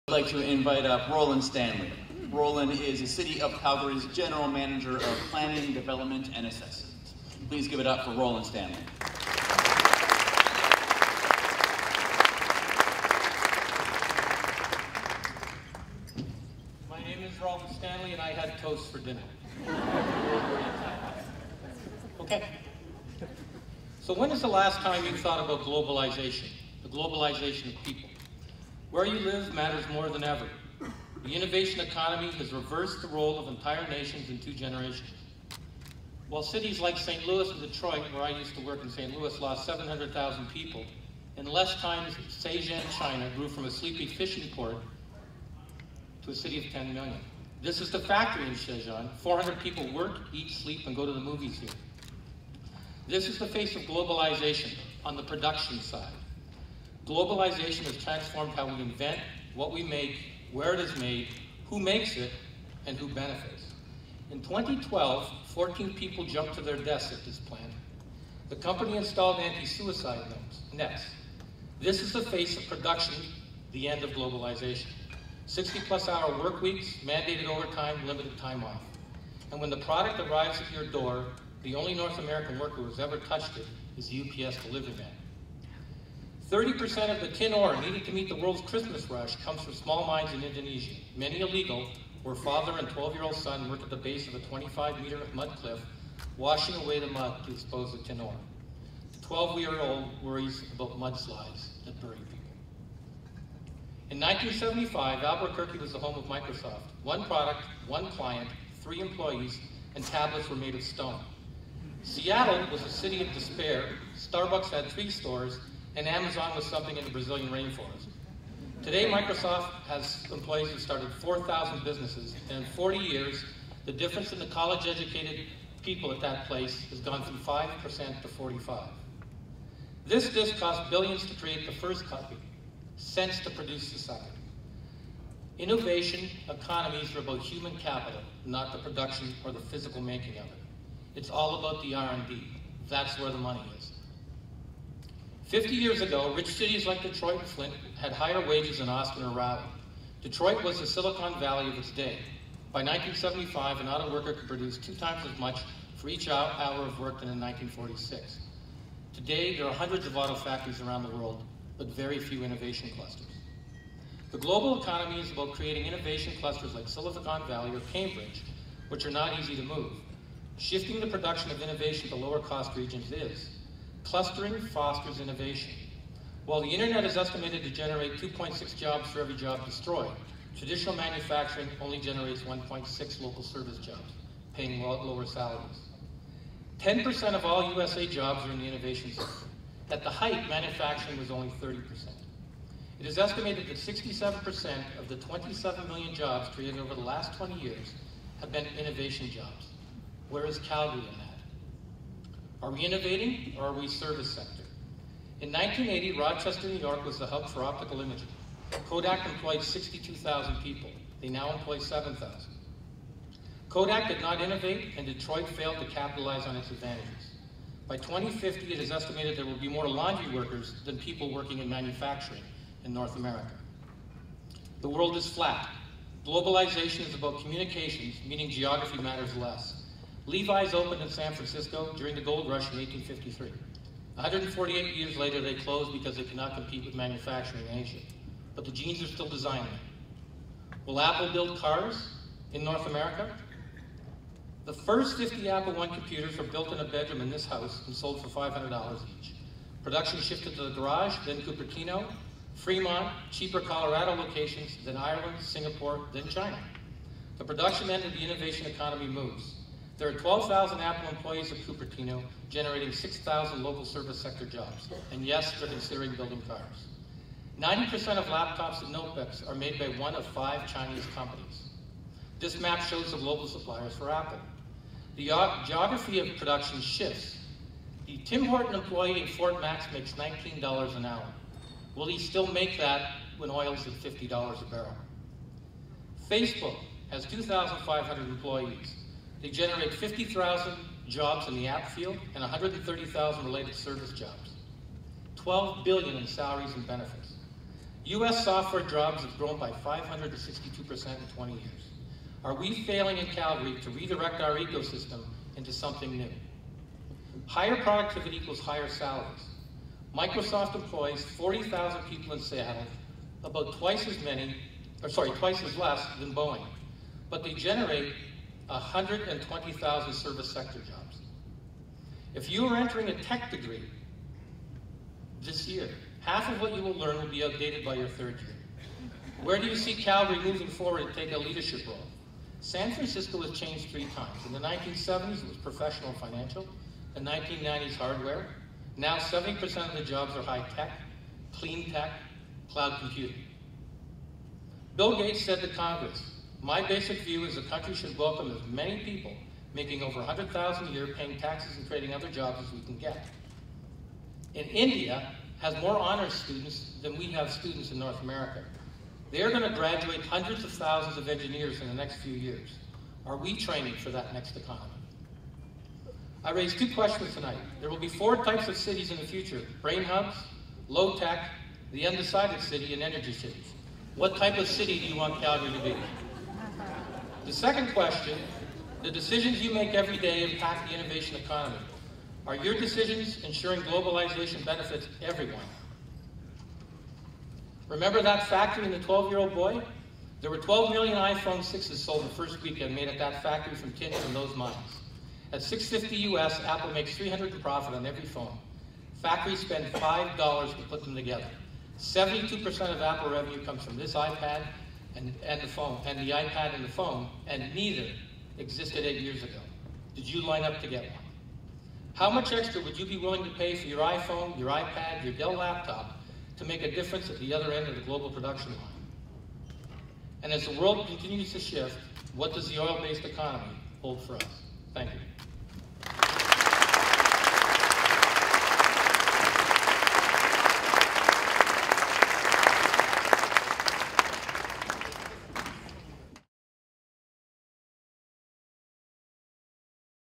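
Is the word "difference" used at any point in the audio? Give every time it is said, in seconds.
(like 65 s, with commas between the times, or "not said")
123 s, 416 s.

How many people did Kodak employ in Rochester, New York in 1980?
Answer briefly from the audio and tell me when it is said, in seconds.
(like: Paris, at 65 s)
62,000, at 209 s.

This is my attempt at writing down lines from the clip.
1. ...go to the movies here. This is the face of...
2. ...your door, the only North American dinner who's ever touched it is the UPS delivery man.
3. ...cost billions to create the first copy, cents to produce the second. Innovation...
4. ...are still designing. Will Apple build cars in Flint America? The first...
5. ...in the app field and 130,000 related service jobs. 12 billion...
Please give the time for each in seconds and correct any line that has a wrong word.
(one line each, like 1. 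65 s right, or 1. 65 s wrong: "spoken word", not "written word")
1. 50 s right
2. 80 s wrong: "worker", not "dinner"
3. 130 s right
4. 239 s wrong: "North", not "Flint"
5. 291 s right.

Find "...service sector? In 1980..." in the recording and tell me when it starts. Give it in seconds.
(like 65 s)
203 s.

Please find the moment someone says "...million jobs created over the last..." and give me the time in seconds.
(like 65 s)
195 s.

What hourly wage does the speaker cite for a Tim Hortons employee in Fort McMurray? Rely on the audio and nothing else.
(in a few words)
$19.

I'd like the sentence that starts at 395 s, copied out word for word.
At 650 US, Apple makes 300 in profit on every phone.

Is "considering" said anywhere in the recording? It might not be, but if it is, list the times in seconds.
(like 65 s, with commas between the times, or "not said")
265 s.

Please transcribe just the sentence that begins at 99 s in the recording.
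The 12-year-old worries about mudslides that bury people.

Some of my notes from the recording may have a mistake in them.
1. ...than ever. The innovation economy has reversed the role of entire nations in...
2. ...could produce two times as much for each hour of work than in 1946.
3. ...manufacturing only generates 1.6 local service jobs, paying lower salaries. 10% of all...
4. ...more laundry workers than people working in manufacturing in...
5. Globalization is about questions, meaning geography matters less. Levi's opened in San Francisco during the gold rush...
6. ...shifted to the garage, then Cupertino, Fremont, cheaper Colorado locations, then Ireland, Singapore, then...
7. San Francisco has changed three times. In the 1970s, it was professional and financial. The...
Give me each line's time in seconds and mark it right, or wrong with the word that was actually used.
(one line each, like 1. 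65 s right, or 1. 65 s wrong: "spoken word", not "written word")
1. 30 s right
2. 154 s right
3. 180 s right
4. 219 s right
5. 226 s wrong: "communications", not "questions"
6. 250 s right
7. 332 s right.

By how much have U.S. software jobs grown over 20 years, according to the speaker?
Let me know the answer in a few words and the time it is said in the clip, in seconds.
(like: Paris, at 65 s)
562%, at 299 s.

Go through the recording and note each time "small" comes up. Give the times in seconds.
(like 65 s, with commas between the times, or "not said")
89 s.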